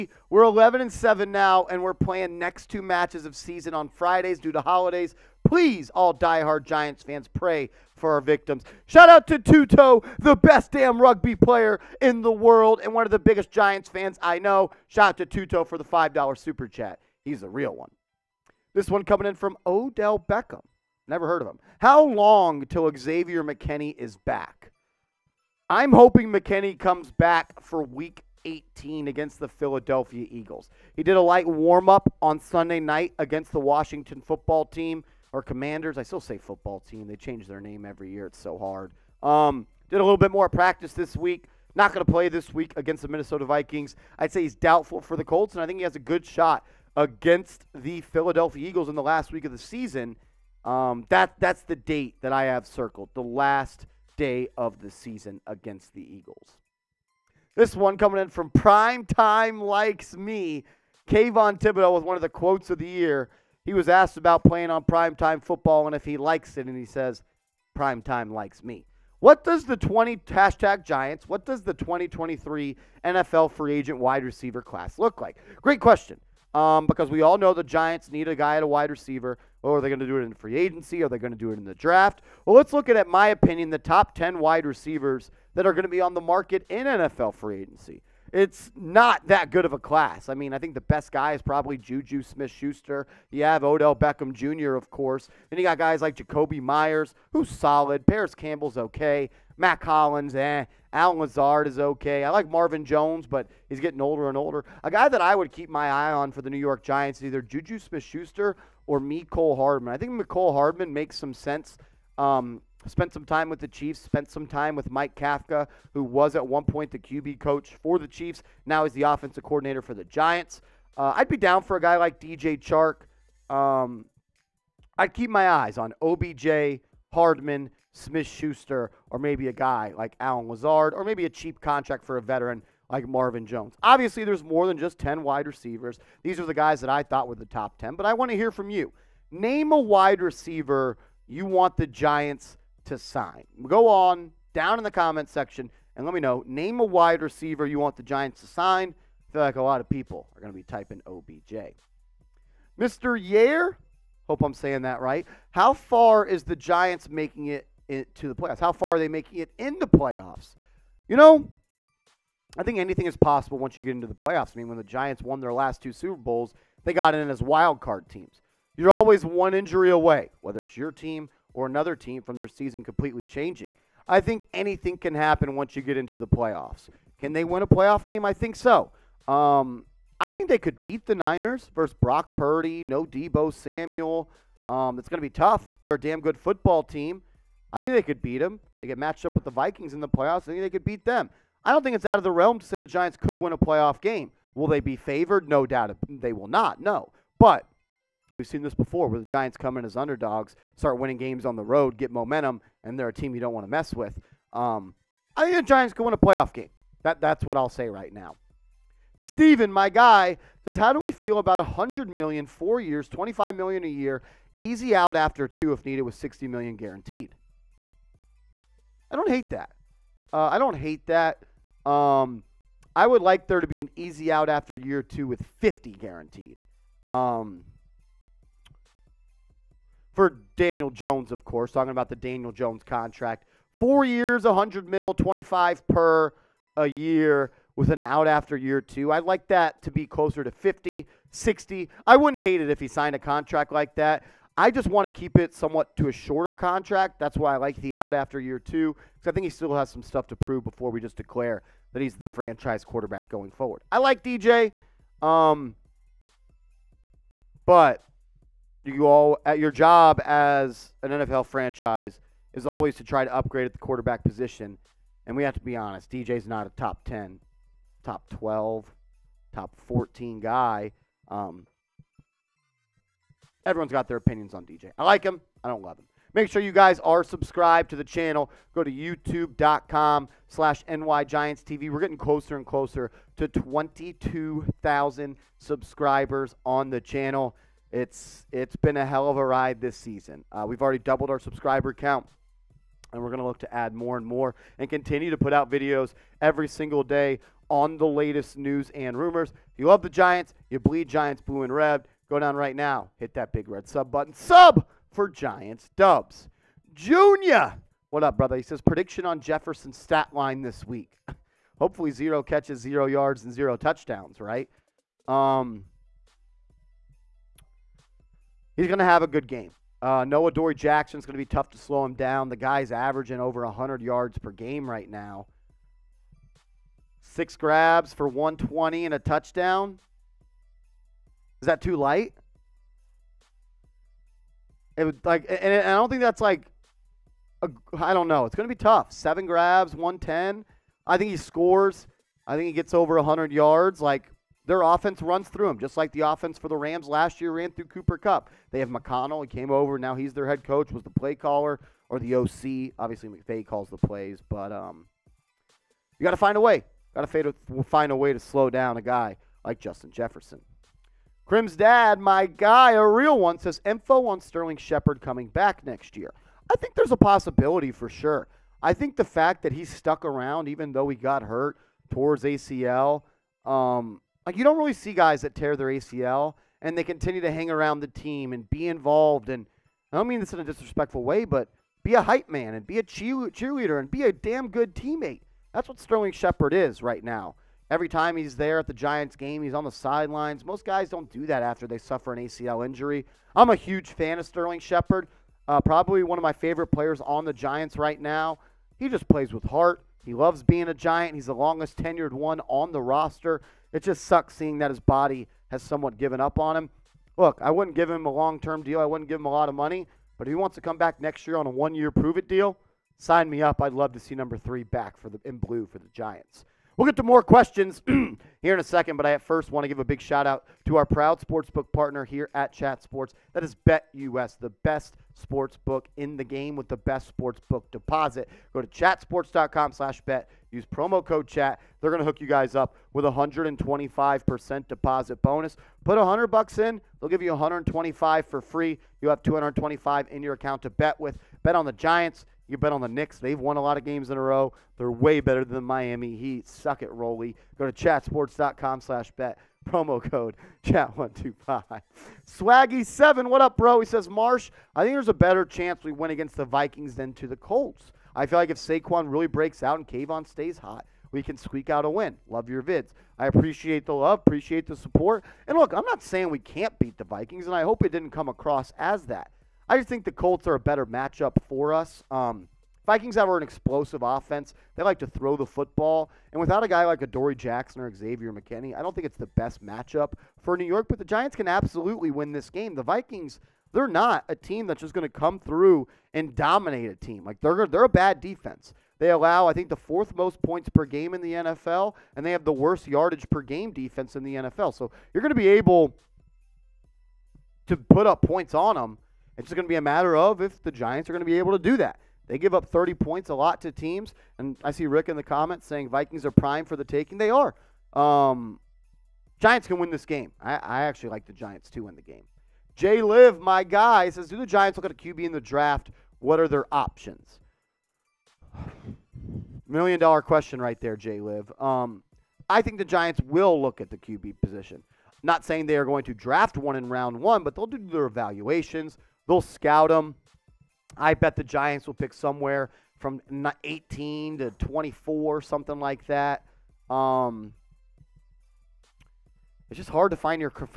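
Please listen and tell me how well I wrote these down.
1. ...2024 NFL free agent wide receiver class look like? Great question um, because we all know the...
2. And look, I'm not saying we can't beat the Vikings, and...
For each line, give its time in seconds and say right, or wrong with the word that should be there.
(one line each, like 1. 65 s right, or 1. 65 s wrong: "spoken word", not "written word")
1. 71 s wrong: "2023", not "2024"
2. 465 s right.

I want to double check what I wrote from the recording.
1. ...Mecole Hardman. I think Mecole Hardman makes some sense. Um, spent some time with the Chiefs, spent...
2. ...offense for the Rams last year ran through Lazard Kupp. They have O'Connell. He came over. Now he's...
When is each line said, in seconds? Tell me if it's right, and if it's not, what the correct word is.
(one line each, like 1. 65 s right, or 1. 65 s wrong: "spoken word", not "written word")
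1. 108 s right
2. 346 s wrong: "Cooper", not "Lazard".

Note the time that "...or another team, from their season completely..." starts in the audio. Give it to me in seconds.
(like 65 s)
171 s.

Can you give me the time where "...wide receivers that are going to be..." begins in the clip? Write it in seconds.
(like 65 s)
84 s.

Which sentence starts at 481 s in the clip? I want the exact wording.
But the Giants can absolutely win this game.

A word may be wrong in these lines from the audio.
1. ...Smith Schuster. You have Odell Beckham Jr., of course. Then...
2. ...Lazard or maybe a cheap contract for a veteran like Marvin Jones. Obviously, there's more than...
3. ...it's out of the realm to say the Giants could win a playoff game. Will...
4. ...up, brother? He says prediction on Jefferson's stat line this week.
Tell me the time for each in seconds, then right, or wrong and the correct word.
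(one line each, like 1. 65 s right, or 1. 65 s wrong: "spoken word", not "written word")
1. 92 s right
2. 130 s right
3. 191 s right
4. 308 s right.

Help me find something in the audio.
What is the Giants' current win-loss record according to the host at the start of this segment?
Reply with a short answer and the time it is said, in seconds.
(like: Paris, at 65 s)
11 and 7, at 0 s.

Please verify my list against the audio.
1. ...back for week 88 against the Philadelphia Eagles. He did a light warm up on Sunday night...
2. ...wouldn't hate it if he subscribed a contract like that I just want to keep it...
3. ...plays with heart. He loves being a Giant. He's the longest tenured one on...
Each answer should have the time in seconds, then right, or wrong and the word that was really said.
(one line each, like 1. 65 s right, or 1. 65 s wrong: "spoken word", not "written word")
1. 27 s wrong: "18", not "88"
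2. 242 s wrong: "signed", not "subscribed"
3. 399 s right.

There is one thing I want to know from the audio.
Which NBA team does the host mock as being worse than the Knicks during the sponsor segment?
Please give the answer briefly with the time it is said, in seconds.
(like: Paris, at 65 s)
Miami Heat, at 445 s.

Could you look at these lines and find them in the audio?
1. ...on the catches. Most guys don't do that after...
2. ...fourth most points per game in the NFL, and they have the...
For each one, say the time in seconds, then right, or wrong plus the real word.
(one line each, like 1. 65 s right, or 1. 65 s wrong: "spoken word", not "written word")
1. 389 s wrong: "sidelines", not "catches"
2. 489 s right.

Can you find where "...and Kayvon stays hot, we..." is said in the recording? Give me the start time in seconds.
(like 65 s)
459 s.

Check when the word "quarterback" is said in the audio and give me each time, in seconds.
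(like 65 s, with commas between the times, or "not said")
252 s, 263 s.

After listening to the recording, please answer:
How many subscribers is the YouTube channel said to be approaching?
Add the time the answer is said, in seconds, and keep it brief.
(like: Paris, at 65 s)
22,000, at 283 s.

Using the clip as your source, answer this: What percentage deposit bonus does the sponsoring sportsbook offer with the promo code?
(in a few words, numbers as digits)
125%.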